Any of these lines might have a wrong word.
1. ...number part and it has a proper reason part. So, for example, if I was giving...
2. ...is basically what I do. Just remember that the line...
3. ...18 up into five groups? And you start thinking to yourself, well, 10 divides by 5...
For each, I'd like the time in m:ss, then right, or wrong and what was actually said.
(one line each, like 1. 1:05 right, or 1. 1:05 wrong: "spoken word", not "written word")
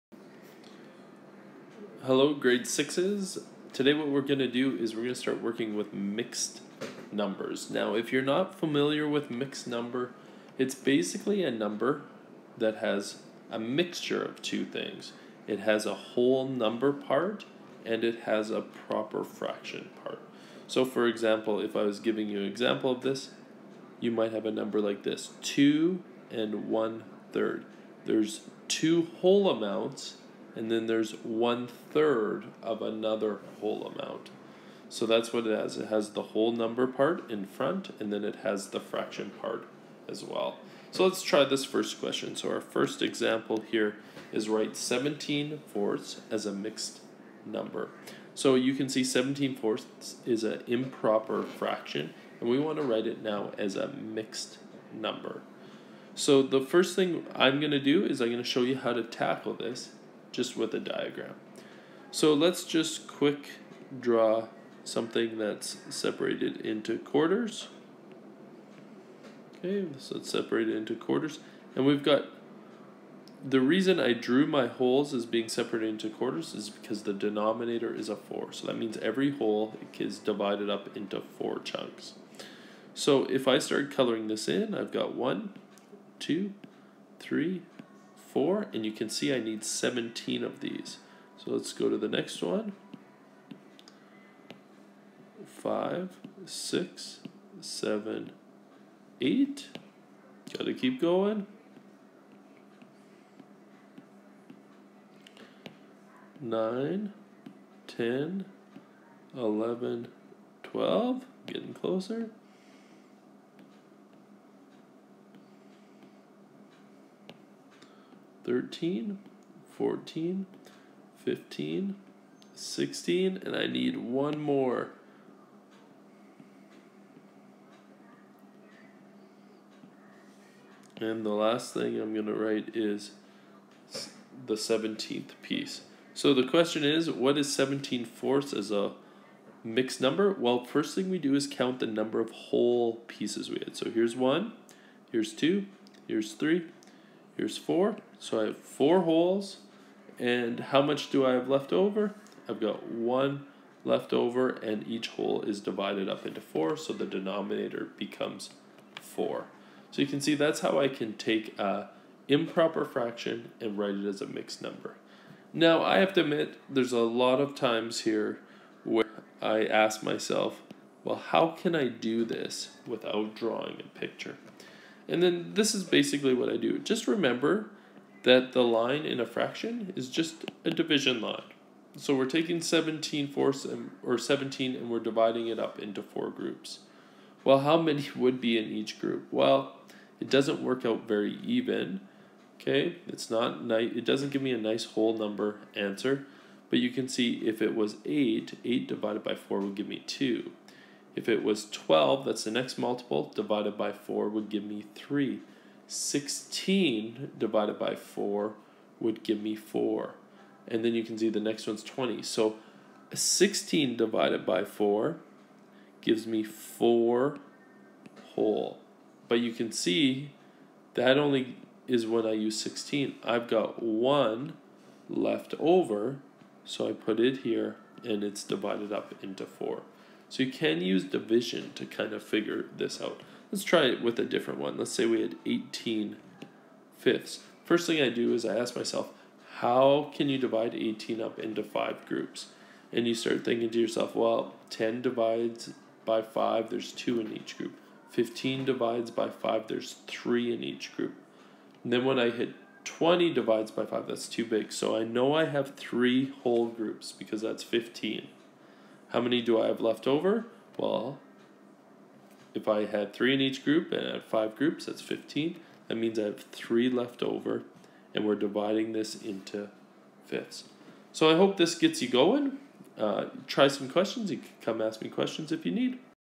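1. 0:16 wrong: "fraction", not "reason"
2. 2:55 right
3. 4:00 right.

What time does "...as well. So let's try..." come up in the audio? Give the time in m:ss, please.
0:40.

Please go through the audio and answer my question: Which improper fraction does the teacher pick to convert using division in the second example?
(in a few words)
18 fifths.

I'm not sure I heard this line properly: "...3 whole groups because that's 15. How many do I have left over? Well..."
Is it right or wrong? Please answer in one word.
right.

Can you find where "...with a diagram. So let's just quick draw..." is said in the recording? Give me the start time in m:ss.
1:00.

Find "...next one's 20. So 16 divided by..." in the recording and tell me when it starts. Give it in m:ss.
3:31.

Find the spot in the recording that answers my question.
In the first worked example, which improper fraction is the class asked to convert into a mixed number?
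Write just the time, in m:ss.
0:44.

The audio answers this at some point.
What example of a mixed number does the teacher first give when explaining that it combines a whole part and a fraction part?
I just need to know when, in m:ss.
0:25.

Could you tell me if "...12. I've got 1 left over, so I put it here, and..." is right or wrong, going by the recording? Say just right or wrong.
wrong.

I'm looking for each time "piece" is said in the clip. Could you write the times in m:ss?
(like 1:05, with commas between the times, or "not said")
2:15, 2:23.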